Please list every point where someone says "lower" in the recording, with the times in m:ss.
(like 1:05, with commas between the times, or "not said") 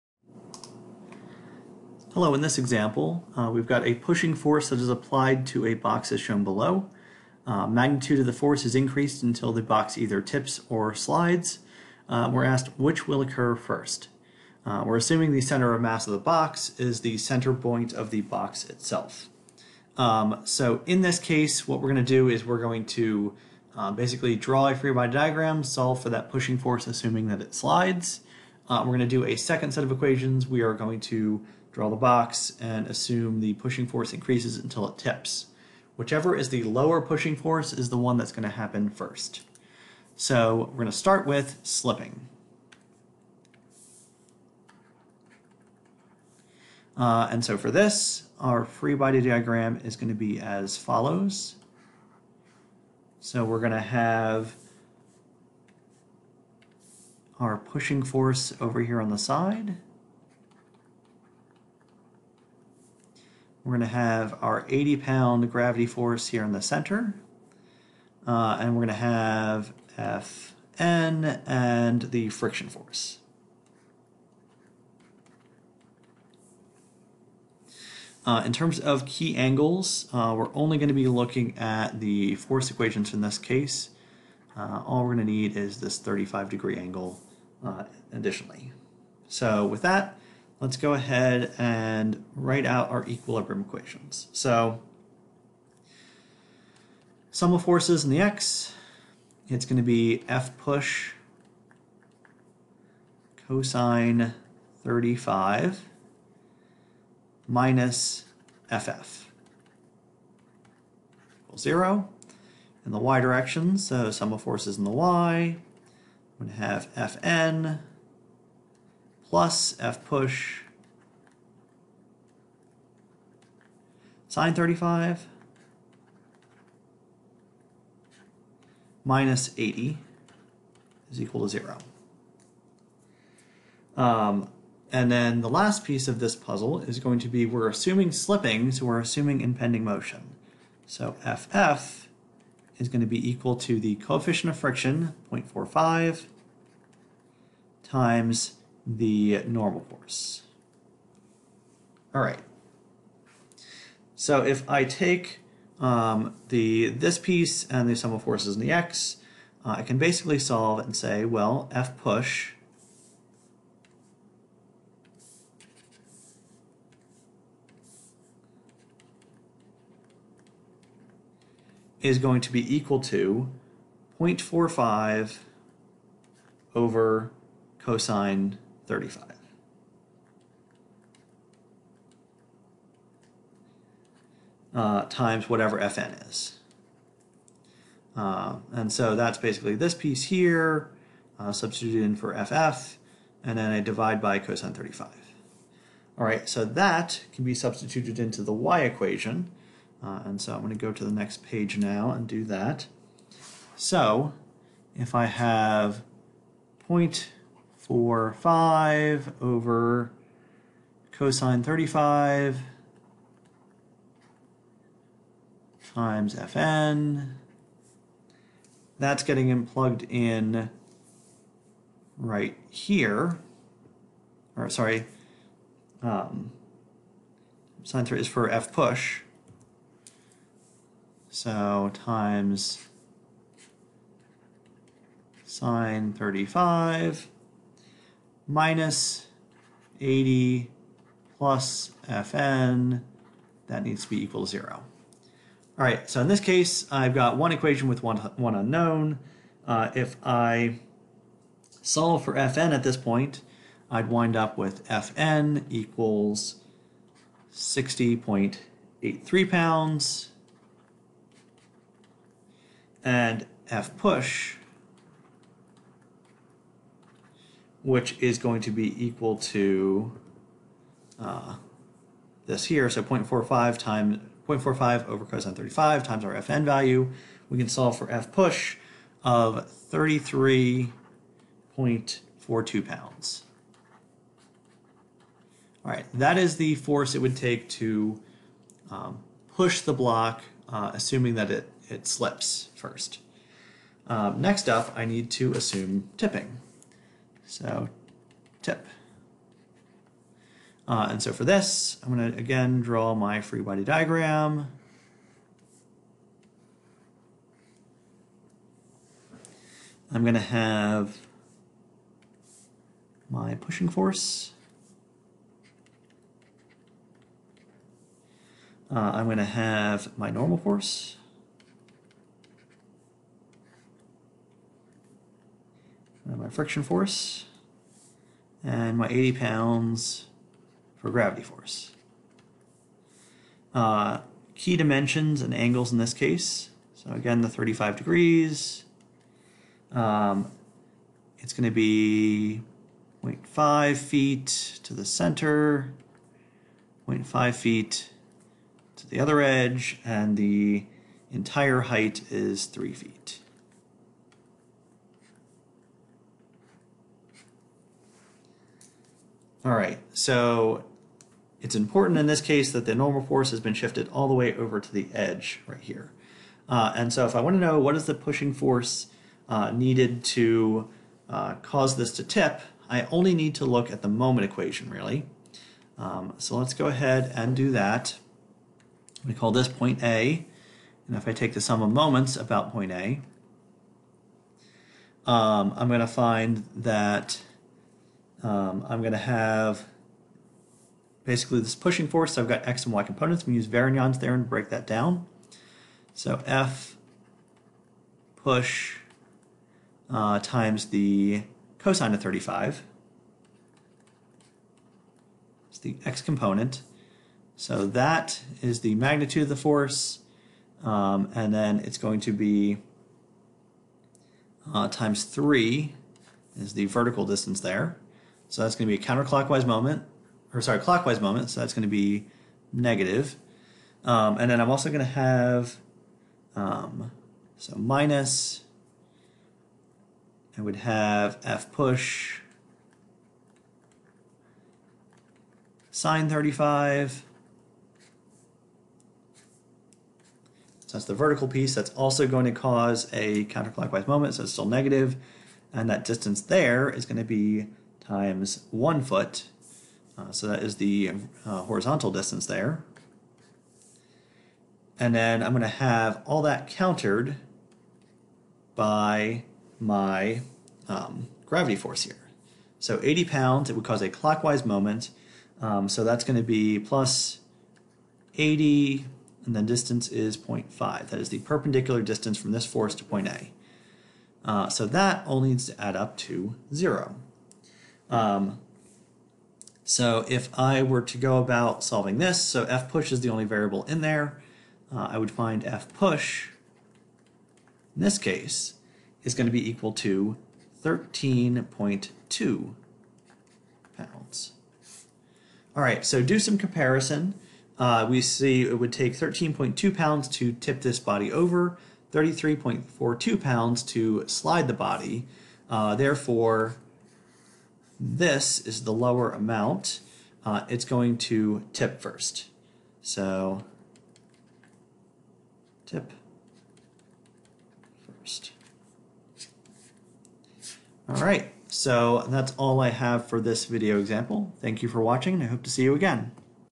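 0:36, 8:28.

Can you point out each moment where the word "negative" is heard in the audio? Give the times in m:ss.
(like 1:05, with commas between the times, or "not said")
7:02, 7:24.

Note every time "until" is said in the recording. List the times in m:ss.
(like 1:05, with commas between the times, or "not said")
0:09, 0:34.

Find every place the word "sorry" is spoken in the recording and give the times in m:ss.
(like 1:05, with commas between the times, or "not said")
3:44, 7:00.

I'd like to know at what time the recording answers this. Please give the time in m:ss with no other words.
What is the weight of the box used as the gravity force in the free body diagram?
1:04.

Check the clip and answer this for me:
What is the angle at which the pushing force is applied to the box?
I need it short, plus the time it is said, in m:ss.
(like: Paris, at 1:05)
35 degrees, at 1:25.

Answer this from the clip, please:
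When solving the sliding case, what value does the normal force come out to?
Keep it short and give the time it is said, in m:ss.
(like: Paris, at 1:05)
60.83 pounds, at 4:17.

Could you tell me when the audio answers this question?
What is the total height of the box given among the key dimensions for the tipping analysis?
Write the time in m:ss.
5:52.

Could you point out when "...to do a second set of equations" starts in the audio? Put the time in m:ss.
0:28.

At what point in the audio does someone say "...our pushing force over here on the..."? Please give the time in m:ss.
0:57.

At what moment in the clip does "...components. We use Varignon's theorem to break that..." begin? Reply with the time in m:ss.
6:33.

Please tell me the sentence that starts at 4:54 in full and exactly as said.
Um, next up, I need to assume tipping.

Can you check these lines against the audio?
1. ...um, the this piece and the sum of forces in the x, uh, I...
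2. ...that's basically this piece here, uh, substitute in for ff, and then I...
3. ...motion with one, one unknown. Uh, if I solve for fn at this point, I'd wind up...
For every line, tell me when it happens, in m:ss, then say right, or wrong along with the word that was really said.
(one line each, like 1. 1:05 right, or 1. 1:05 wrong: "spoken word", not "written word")
1. 2:35 right
2. 3:09 right
3. 4:07 wrong: "equation", not "motion".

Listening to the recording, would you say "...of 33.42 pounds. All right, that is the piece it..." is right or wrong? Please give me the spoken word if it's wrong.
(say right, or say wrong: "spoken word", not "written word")
wrong: "force", not "piece".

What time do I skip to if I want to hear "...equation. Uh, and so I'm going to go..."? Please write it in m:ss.
3:18.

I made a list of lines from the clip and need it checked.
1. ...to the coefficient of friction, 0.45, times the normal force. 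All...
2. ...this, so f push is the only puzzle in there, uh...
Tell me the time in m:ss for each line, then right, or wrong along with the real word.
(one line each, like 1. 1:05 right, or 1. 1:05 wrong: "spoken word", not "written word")
1. 2:23 right
2. 8:02 wrong: "variable", not "puzzle".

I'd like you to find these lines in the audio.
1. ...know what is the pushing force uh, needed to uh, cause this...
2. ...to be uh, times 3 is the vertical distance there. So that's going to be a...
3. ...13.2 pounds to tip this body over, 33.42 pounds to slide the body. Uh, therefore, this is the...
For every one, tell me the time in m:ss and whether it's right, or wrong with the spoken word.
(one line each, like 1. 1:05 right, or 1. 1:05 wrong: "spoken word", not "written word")
1. 6:07 right
2. 6:52 right
3. 8:19 right.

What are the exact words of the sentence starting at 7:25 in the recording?
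And that distance there is going to be times one foot.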